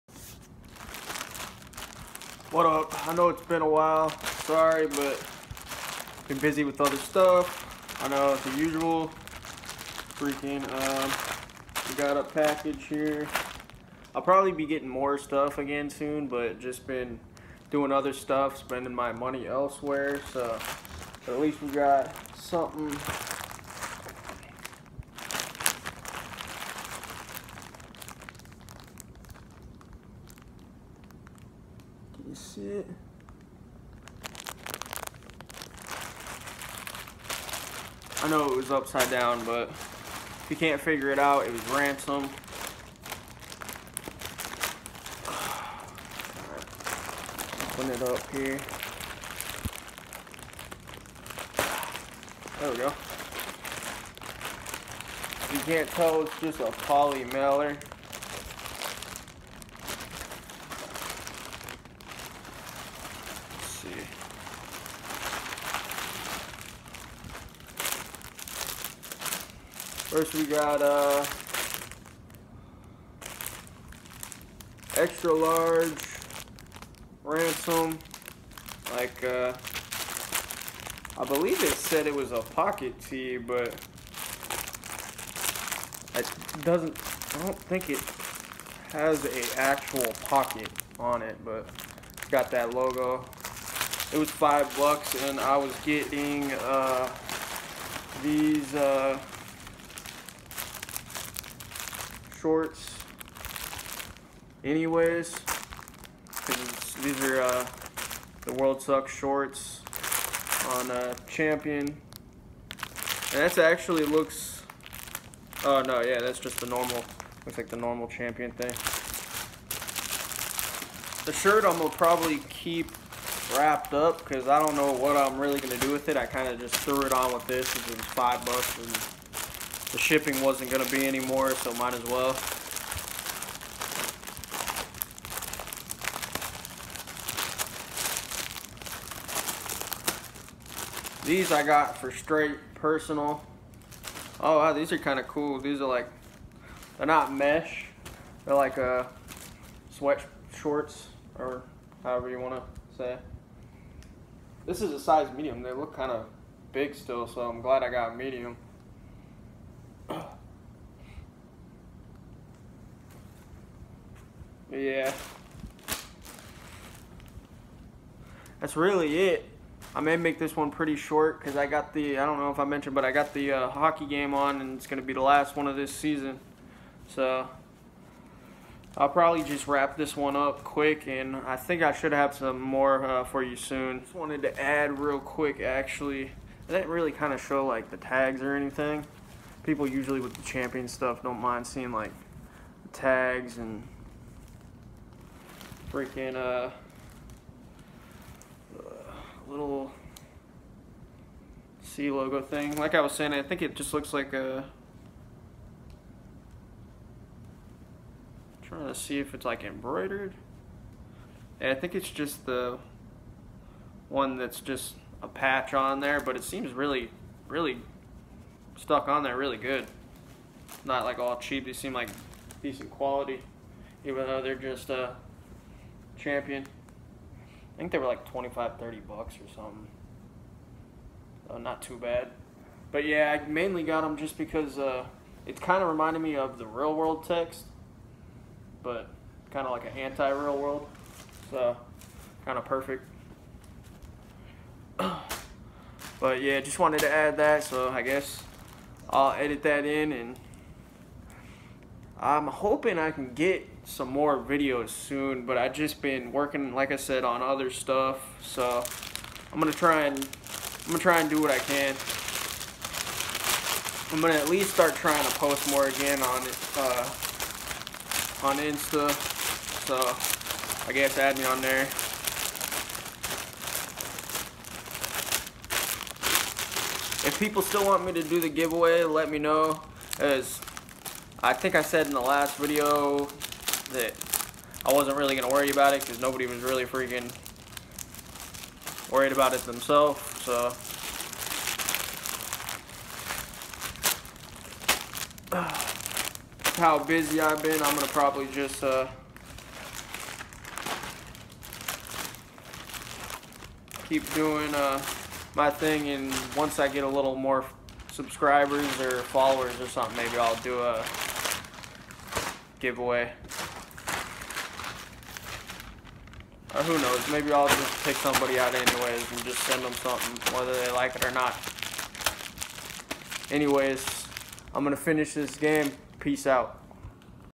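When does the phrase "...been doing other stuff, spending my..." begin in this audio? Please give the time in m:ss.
0:16.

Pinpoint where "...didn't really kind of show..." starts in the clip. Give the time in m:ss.
3:06.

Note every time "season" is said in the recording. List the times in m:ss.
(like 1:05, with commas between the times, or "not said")
2:55.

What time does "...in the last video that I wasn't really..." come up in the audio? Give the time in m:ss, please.
4:42.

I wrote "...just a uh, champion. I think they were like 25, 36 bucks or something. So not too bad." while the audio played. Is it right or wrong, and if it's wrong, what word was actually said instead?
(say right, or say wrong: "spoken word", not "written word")
wrong: "30", not "36".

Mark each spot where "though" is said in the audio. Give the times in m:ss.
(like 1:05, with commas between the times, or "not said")
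3:44.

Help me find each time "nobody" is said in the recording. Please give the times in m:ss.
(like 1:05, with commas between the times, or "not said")
4:46.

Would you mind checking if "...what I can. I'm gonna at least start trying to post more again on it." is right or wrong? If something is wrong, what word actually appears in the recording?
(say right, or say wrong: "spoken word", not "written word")
right.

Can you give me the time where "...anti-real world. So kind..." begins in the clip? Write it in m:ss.
3:59.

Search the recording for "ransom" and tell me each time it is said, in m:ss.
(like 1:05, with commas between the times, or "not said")
0:41, 1:17.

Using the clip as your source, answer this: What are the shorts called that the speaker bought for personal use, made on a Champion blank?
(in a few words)
World Sucks.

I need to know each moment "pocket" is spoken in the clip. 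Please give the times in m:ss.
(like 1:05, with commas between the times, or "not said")
1:22, 1:30.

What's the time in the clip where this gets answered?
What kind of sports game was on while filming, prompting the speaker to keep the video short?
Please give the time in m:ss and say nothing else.
2:53.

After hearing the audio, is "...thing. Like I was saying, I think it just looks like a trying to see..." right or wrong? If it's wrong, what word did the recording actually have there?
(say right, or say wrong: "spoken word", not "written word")
right.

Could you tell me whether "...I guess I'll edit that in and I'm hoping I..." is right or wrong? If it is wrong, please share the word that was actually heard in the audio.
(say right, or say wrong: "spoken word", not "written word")
right.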